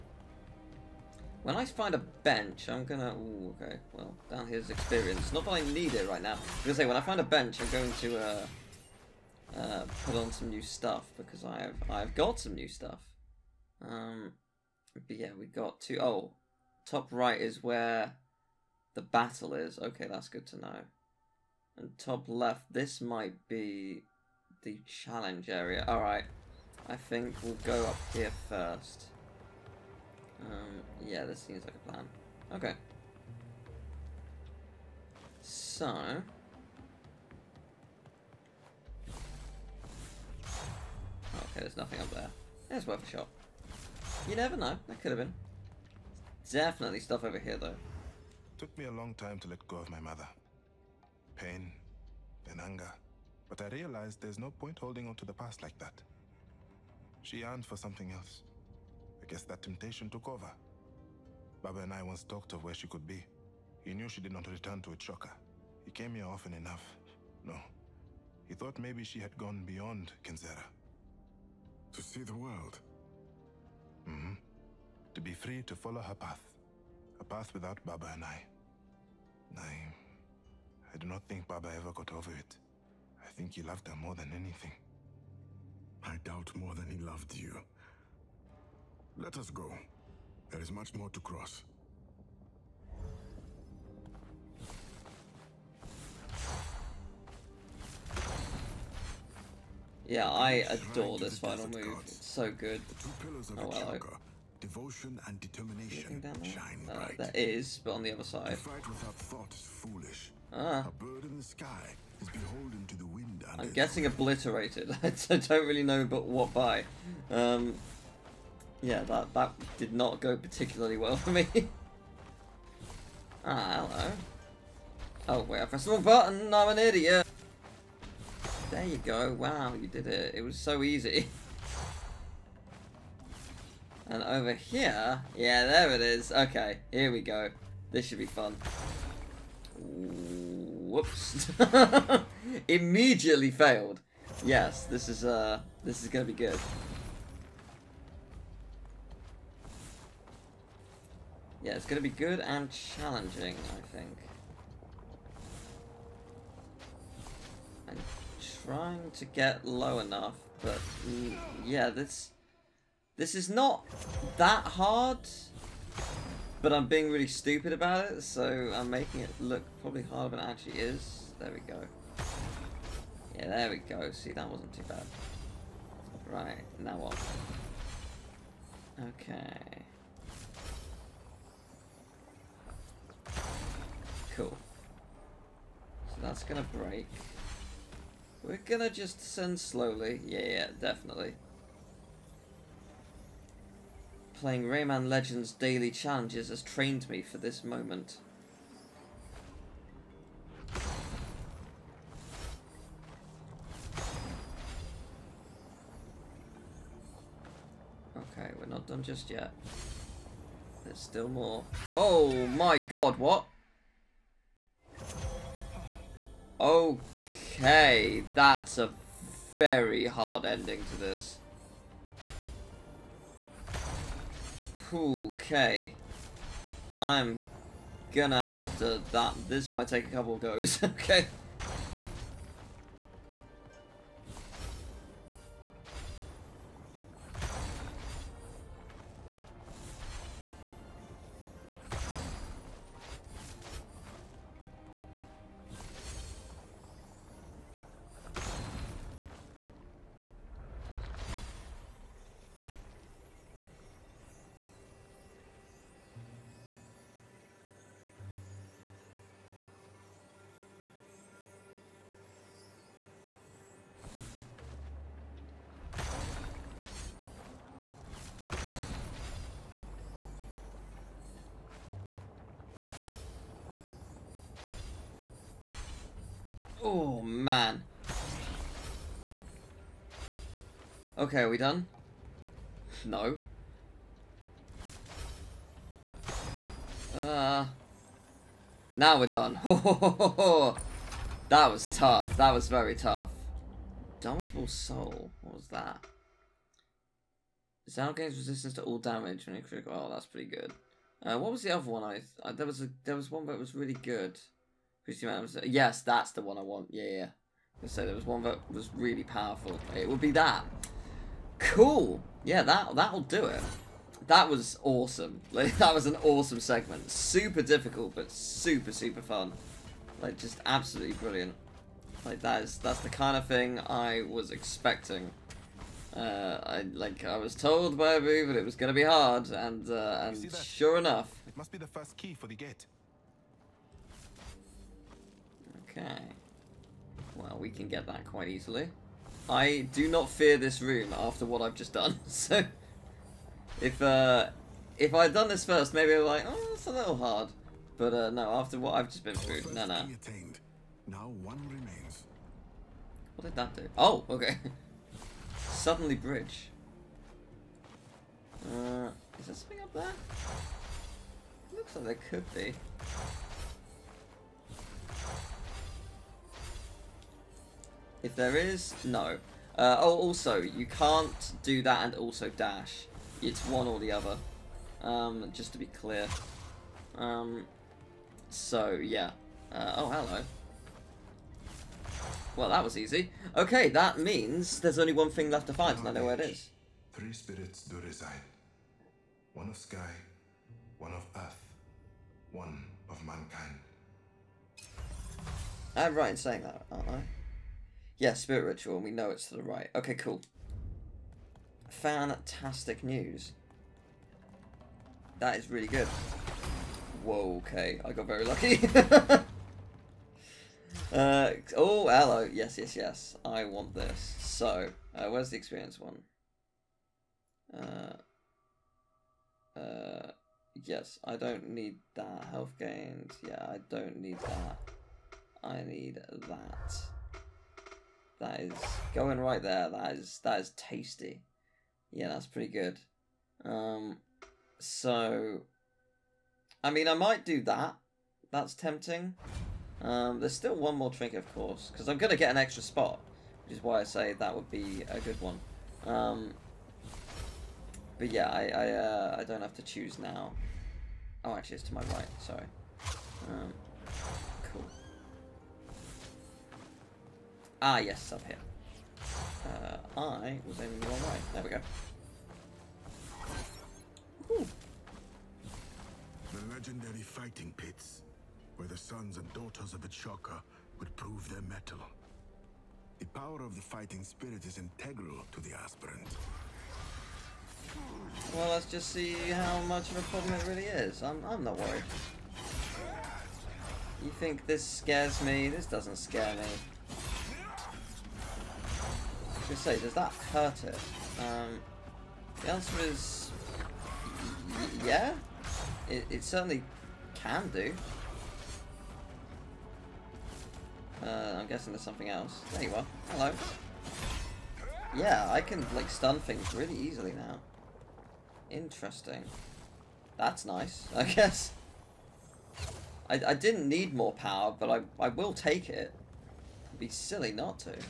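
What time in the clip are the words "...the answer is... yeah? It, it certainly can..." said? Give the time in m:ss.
8:12.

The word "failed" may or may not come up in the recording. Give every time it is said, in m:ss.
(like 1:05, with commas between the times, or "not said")
2:23.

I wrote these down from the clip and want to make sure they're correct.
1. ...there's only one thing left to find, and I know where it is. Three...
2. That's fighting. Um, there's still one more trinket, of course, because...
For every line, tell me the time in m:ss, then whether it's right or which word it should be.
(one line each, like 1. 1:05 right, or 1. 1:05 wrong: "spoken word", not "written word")
1. 6:24 right
2. 7:18 wrong: "tempting", not "fighting".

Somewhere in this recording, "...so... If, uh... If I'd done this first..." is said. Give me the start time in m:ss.
5:42.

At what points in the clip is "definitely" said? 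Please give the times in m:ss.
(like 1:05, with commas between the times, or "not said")
0:46, 3:10.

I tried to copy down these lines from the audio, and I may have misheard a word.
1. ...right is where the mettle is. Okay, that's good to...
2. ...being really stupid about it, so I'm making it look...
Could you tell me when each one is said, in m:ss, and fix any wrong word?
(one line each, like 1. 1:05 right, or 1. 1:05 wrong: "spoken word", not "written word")
1. 0:17 wrong: "battle", not "mettle"
2. 2:46 right.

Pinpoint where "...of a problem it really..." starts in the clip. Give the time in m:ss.
8:00.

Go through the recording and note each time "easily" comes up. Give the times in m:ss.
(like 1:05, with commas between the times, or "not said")
5:38, 8:26.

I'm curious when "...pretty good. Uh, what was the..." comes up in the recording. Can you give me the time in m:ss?
5:00.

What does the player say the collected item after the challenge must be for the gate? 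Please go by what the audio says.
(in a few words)
The first key.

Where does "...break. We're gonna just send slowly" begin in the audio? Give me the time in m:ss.
3:06.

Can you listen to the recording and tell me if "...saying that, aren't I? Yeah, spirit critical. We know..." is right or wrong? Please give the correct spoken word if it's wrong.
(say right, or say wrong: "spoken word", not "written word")
wrong: "ritual", not "critical".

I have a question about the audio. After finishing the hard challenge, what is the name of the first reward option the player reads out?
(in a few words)
Domitable Soul.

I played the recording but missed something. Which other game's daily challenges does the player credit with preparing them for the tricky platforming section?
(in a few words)
Rayman Legends.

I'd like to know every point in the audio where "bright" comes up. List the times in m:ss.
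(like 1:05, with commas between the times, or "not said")
1:46.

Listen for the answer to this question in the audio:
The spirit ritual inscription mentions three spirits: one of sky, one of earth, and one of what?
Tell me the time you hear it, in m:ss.
6:33.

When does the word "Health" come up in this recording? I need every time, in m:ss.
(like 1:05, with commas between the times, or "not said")
7:02.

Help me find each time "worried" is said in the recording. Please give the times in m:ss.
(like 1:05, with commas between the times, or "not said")
8:01.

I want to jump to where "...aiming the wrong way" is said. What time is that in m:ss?
7:40.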